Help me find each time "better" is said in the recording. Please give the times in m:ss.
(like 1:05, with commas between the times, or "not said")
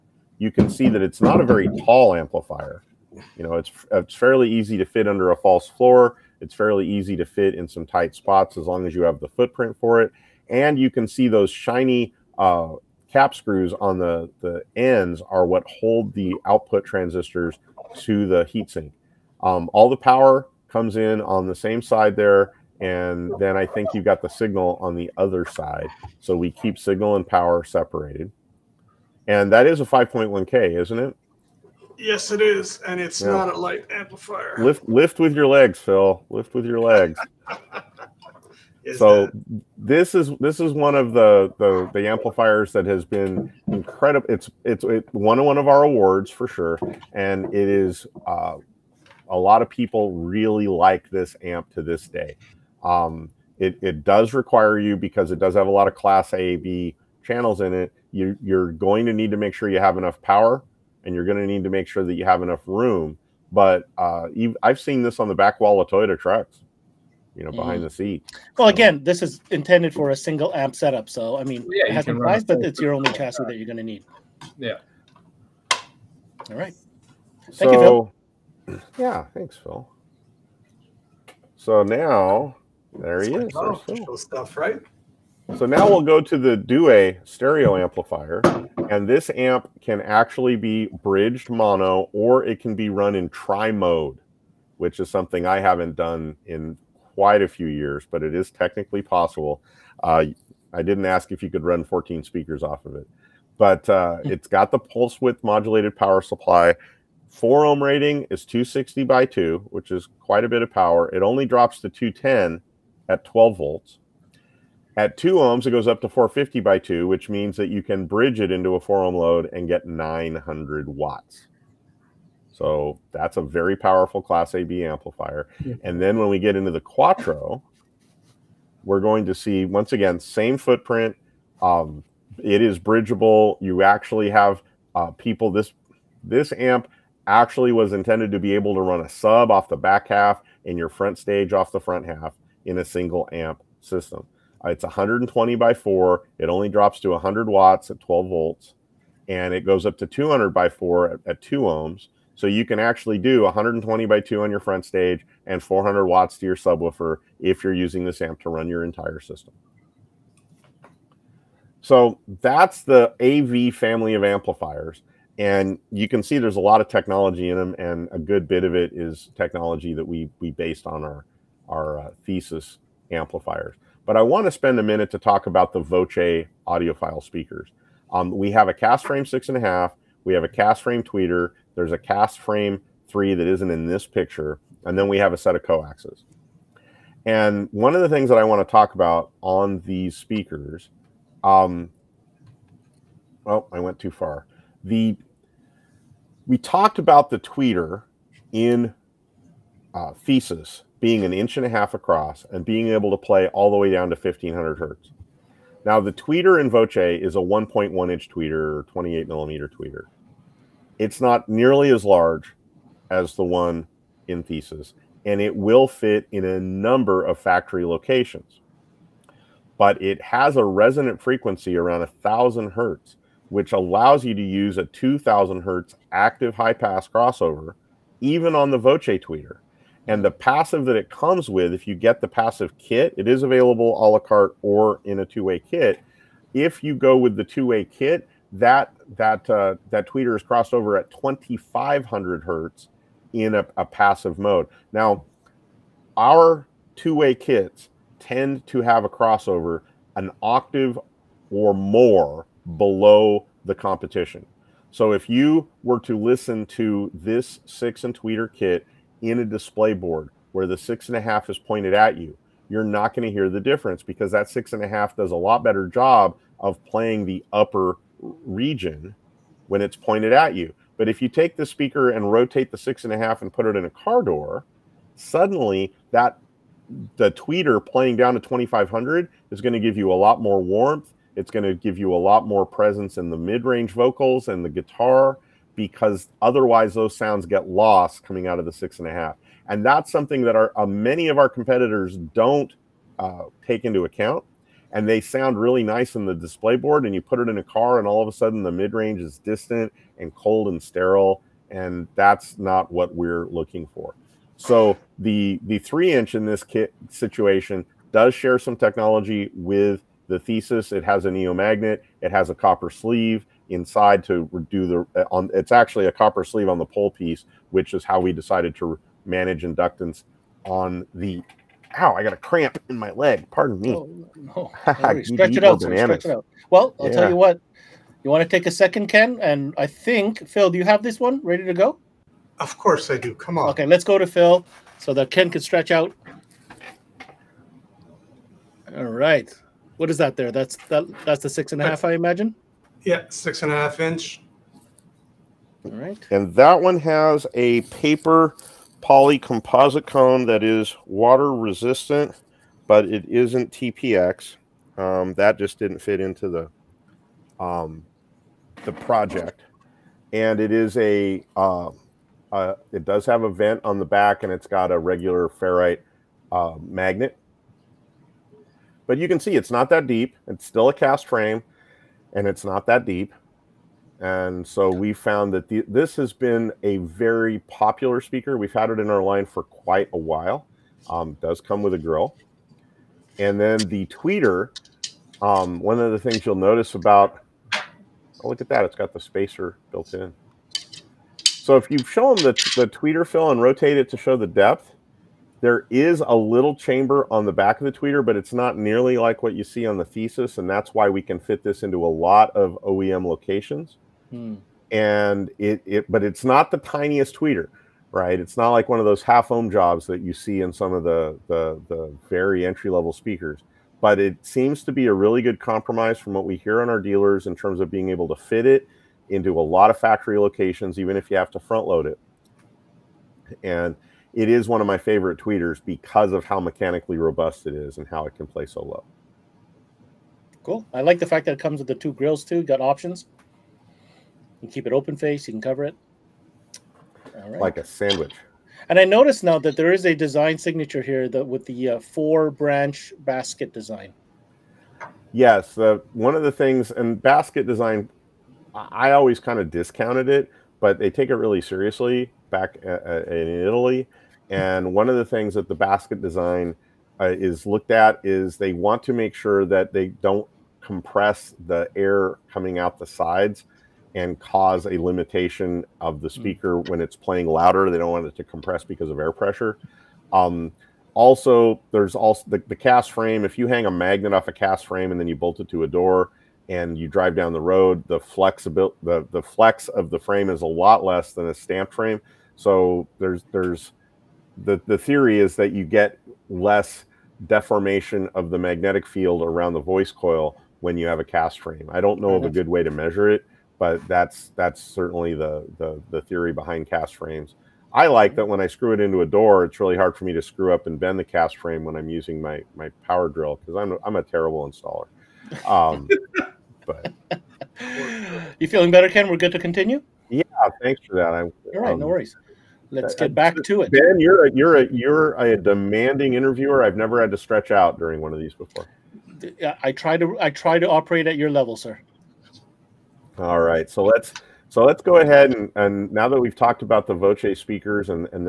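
4:25, 8:28.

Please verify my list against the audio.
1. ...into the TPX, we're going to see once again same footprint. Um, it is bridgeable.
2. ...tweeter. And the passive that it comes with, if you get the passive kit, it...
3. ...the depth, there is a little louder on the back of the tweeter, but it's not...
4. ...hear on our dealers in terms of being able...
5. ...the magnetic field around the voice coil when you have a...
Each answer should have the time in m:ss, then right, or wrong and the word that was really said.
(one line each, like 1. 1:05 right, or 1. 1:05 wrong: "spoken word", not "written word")
1. 2:06 wrong: "Quattro", not "TPX"
2. 3:49 right
3. 6:34 wrong: "chamber", not "louder"
4. 6:56 right
5. 8:08 right.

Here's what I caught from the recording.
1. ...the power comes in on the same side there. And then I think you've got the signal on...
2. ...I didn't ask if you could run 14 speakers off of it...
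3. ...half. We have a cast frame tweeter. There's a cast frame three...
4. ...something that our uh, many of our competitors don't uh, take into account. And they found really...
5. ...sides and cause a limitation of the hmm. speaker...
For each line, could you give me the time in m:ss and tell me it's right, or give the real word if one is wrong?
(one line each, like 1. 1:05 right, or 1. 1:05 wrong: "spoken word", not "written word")
1. 0:19 right
2. 1:40 right
3. 2:59 right
4. 4:50 wrong: "sound", not "found"
5. 7:43 right.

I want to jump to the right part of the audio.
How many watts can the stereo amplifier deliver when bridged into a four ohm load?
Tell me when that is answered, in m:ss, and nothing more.
1:59.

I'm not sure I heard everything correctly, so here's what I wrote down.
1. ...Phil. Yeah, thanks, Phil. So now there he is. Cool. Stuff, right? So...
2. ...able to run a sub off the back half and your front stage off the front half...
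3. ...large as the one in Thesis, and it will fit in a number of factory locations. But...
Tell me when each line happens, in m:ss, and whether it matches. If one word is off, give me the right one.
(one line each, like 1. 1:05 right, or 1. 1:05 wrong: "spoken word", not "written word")
1. 1:18 right
2. 2:18 right
3. 3:32 right.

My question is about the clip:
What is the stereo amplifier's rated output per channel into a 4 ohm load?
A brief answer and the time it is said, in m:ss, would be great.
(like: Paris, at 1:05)
260 watts, at 1:48.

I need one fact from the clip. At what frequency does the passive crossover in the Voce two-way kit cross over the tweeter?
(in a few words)
2,500 hertz.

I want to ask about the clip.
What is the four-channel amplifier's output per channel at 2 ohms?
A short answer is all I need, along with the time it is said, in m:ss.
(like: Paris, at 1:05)
200 watts, at 2:30.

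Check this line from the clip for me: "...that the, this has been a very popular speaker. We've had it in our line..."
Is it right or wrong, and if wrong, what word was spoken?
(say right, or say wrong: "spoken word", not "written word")
right.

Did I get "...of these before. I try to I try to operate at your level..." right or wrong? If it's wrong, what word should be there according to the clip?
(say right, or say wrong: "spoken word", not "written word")
right.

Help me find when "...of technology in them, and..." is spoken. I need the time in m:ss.
2:46.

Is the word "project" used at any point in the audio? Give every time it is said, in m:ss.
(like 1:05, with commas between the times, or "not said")
5:58.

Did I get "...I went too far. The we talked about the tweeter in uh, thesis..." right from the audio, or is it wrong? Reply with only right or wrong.
right.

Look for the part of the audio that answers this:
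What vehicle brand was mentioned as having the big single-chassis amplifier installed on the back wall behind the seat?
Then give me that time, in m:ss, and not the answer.
1:05.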